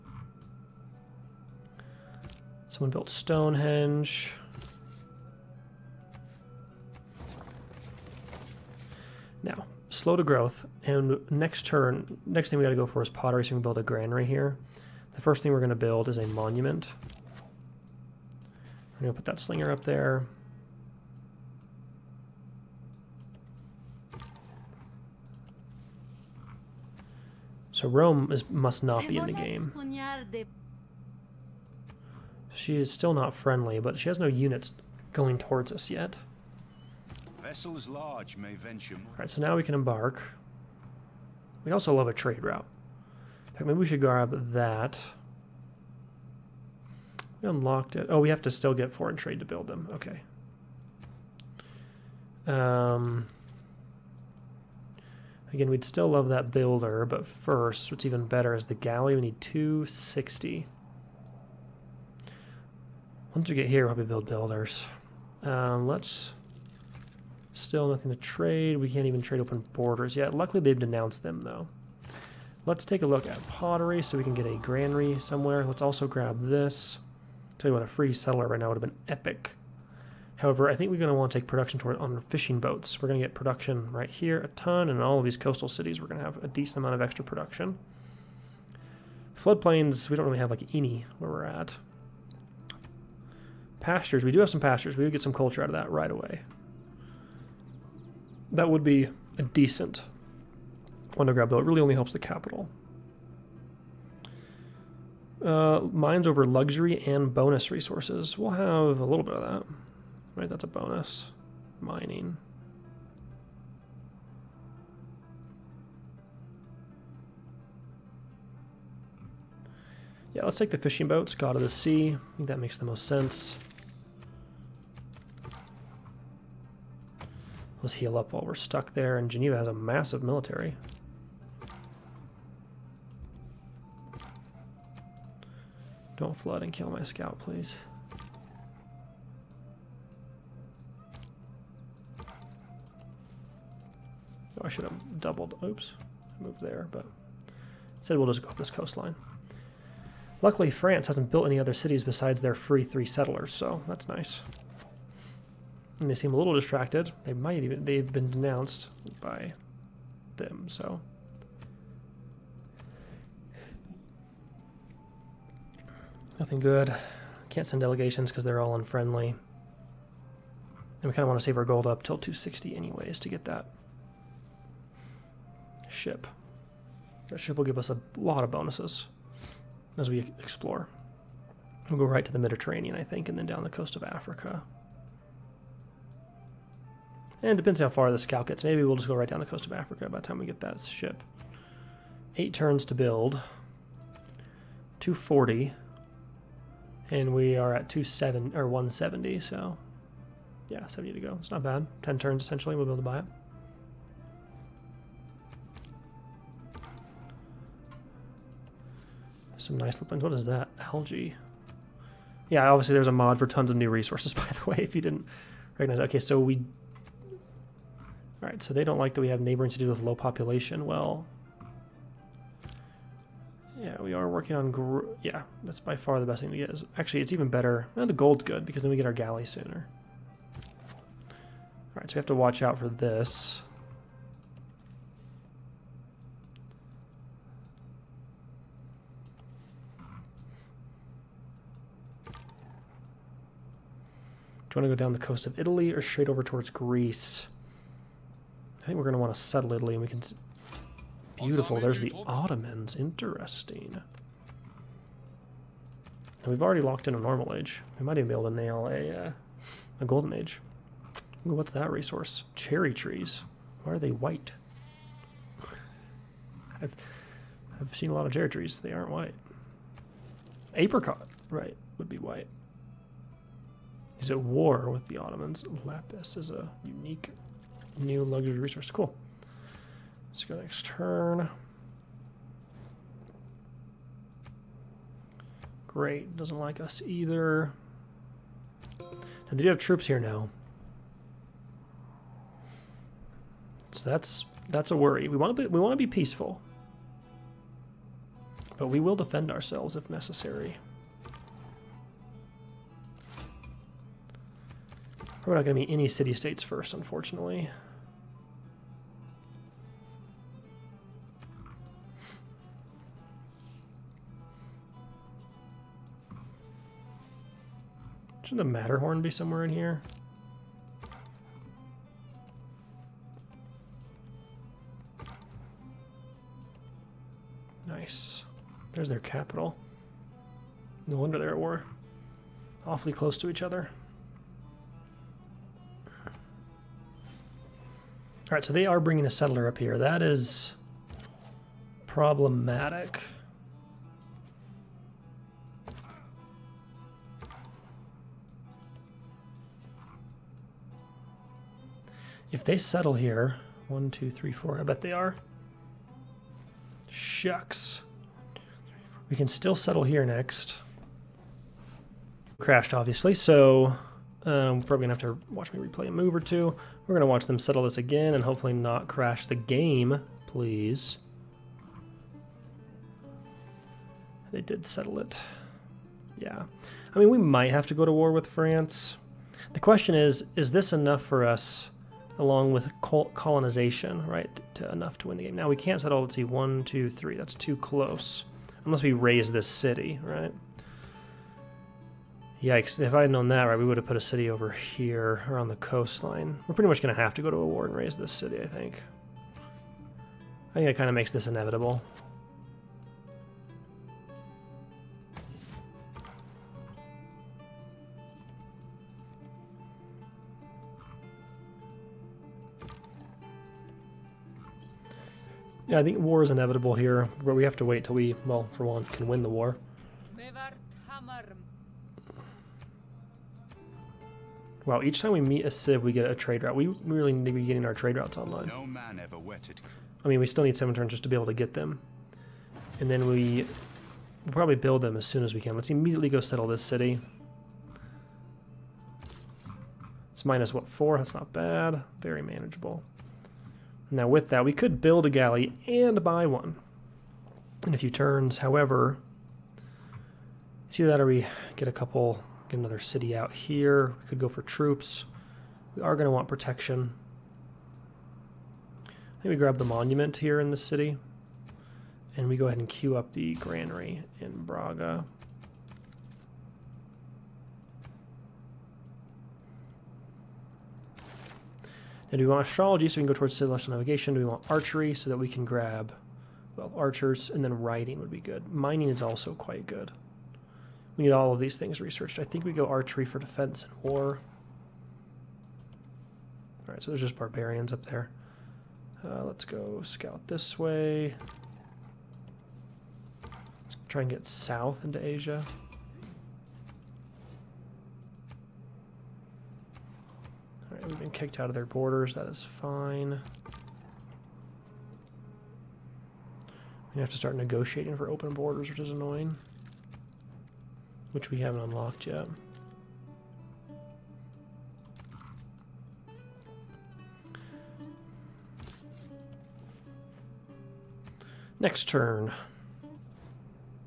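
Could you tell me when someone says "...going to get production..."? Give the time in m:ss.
1:23.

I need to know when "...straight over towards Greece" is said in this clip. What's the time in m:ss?
4:06.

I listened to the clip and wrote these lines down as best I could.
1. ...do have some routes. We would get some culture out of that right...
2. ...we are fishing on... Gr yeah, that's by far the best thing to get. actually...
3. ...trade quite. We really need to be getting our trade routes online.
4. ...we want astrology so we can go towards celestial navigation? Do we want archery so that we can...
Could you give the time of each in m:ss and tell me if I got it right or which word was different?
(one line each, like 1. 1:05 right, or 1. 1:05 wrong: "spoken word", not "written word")
1. 1:34 wrong: "pastures", not "routes"
2. 3:44 wrong: "working", not "fishing"
3. 7:06 wrong: "route", not "quite"
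4. 7:52 right.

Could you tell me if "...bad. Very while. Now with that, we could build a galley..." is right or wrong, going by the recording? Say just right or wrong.
wrong.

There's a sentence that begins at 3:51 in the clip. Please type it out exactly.
Alright, so we have to watch out for this.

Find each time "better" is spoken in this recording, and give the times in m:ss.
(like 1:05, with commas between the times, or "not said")
0:58, 3:47.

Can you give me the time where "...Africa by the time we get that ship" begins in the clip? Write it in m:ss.
3:09.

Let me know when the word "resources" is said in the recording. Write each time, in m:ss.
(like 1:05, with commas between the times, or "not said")
1:47, 3:33, 4:21, 4:38.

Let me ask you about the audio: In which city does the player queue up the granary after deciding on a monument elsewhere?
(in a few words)
Braga.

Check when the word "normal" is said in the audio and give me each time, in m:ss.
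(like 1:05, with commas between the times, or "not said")
4:17.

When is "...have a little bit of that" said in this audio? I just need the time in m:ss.
1:48.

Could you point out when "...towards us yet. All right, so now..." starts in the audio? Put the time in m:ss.
0:35.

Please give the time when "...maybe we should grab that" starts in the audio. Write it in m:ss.
0:43.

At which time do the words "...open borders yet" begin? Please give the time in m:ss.
1:09.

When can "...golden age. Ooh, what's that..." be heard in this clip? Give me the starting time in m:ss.
4:20.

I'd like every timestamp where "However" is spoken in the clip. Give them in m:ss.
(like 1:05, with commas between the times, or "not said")
1:20, 7:28.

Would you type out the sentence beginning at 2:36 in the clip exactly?
And they seem a little distracted.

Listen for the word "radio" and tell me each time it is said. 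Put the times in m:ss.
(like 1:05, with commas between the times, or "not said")
not said.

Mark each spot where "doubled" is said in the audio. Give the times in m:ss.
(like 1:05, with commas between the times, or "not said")
2:25.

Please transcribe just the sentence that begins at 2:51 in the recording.
And we kind of want to save our gold up till 260 anyways to get that ship.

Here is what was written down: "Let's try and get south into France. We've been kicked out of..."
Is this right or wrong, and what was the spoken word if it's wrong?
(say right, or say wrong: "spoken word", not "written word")
wrong: "Asia", not "France".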